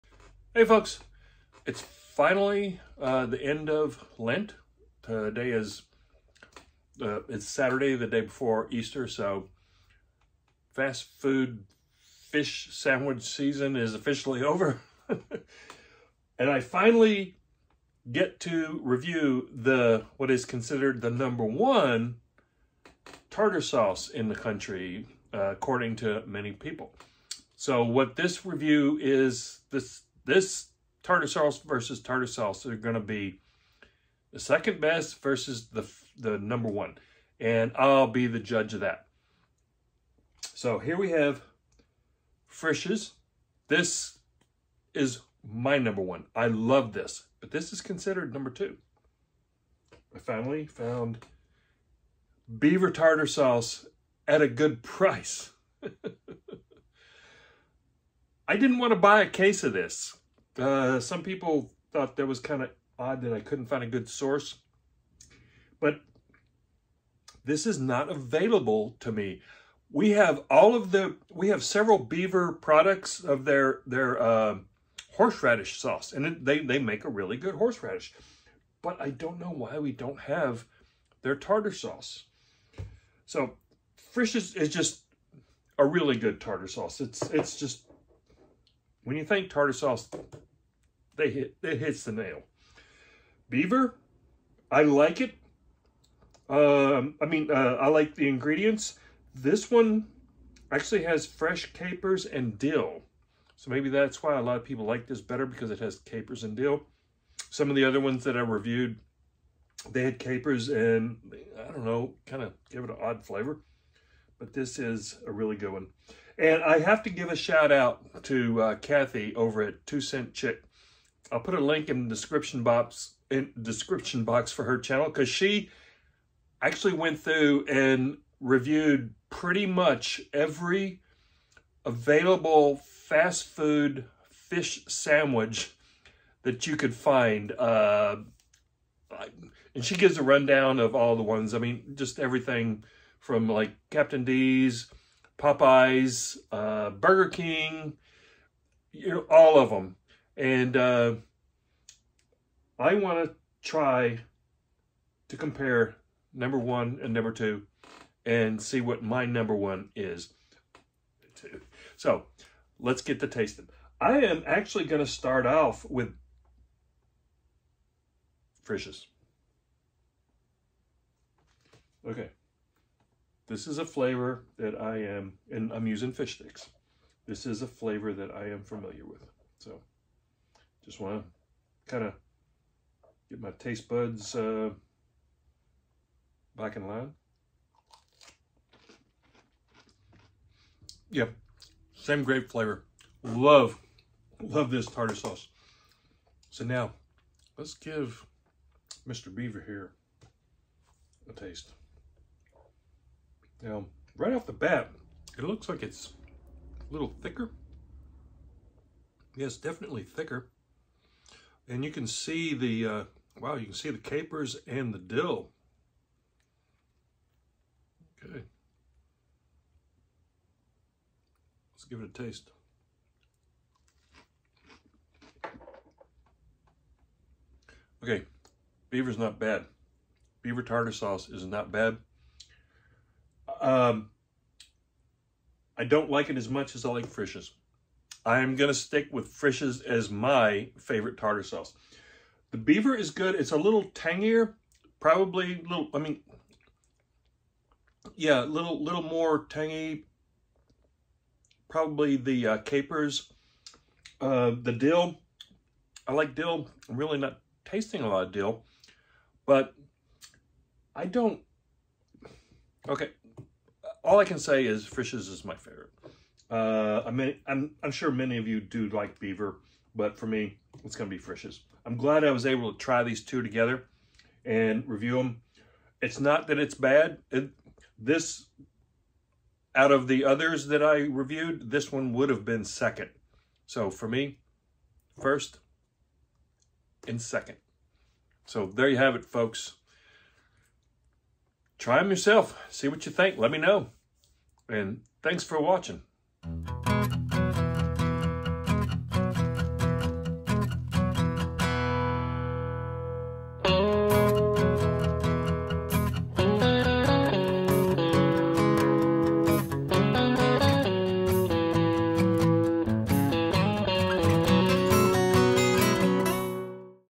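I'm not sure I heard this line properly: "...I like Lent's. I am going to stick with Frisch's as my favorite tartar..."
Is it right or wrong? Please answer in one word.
wrong.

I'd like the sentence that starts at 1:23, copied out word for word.
So Frisch is, is just a really good tartar sauce.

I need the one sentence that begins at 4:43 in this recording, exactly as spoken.
So for me, first and second.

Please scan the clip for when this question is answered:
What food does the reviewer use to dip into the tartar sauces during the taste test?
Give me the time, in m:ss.
2:56.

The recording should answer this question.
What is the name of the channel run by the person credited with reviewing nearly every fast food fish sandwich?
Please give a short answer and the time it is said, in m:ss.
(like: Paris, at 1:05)
Two Cent Chick, at 1:59.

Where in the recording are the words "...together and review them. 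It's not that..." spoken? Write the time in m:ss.
4:33.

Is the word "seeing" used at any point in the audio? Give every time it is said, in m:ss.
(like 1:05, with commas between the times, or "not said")
not said.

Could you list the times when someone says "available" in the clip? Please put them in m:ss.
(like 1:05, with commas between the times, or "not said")
1:08, 2:11.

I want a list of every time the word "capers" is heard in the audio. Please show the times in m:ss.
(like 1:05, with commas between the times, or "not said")
1:41, 1:45, 1:50, 3:33, 4:12.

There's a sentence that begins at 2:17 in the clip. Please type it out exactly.
Uh, and she gives a rundown of all the ones.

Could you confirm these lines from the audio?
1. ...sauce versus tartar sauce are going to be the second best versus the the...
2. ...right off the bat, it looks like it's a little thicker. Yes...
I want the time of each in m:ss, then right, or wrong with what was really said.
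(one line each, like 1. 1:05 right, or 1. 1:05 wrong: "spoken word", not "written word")
1. 0:31 right
2. 3:24 right.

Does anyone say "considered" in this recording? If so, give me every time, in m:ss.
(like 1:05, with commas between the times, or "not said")
0:20, 0:47.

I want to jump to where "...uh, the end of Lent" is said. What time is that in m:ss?
0:03.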